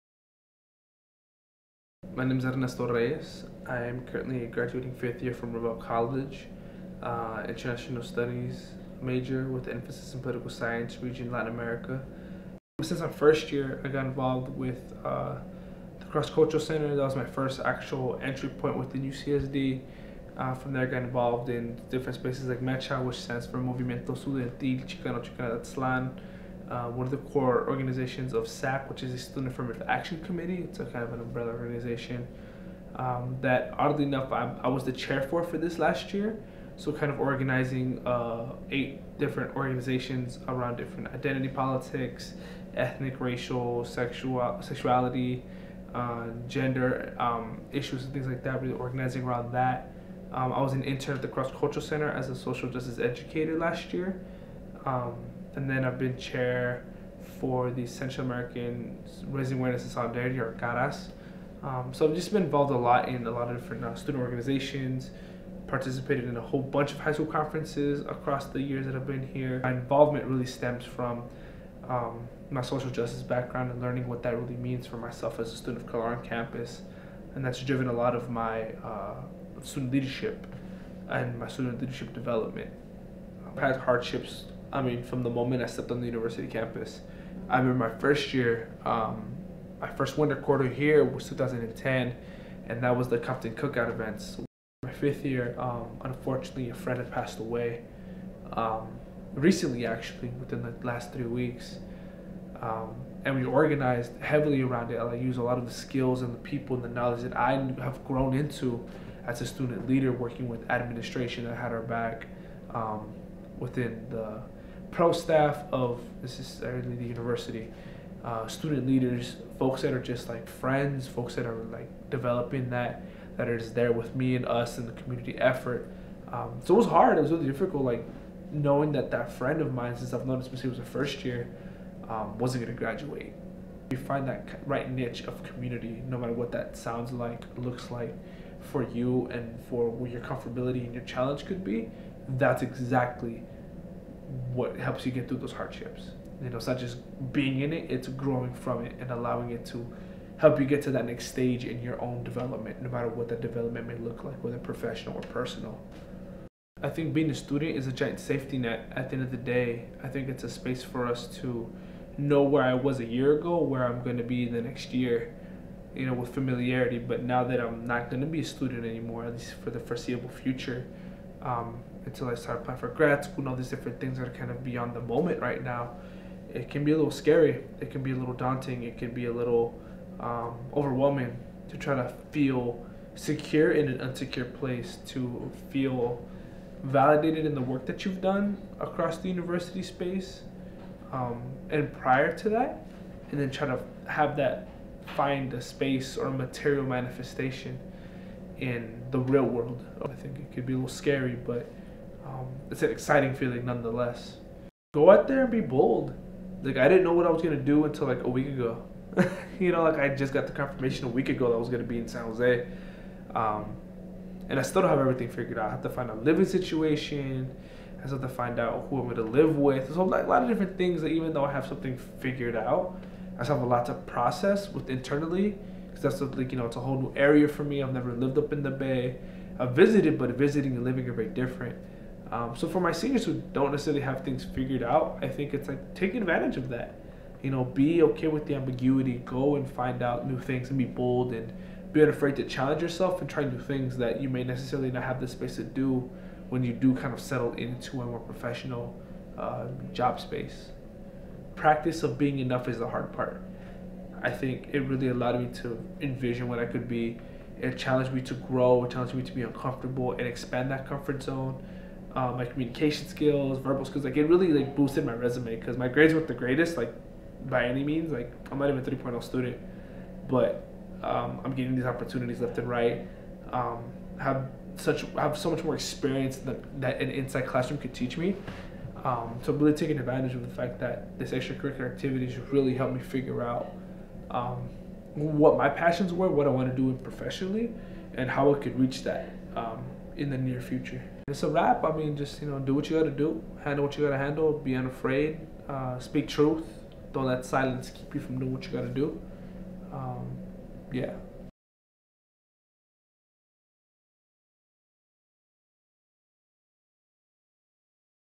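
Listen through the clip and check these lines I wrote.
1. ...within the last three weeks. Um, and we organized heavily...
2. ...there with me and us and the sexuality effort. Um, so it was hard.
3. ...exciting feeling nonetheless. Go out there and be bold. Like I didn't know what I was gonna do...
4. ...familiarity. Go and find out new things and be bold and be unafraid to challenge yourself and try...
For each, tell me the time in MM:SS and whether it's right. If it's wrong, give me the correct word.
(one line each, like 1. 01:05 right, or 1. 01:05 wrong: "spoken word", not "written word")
1. 01:40 right
2. 02:03 wrong: "community", not "sexuality"
3. 03:22 right
4. 03:58 wrong: "ambiguity", not "familiarity".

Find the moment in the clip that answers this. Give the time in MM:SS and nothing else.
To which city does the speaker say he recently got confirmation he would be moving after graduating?
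03:32.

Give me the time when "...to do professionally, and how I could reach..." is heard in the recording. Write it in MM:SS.
04:46.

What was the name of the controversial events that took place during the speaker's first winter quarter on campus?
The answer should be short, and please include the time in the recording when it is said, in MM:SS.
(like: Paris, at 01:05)
Compton Cookout, at 01:33.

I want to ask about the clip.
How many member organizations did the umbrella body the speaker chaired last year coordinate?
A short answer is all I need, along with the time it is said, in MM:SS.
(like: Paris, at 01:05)
8, at 00:38.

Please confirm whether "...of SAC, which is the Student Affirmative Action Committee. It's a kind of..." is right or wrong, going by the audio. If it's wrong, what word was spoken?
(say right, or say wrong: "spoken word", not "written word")
right.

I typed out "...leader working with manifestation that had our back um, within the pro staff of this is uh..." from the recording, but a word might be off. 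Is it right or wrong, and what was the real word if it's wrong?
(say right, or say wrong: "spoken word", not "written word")
wrong: "administration", not "manifestation".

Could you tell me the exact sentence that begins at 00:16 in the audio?
That was my first actual entry point within UCSD.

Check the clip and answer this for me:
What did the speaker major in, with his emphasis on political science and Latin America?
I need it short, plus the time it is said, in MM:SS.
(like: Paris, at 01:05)
International Studies, at 00:07.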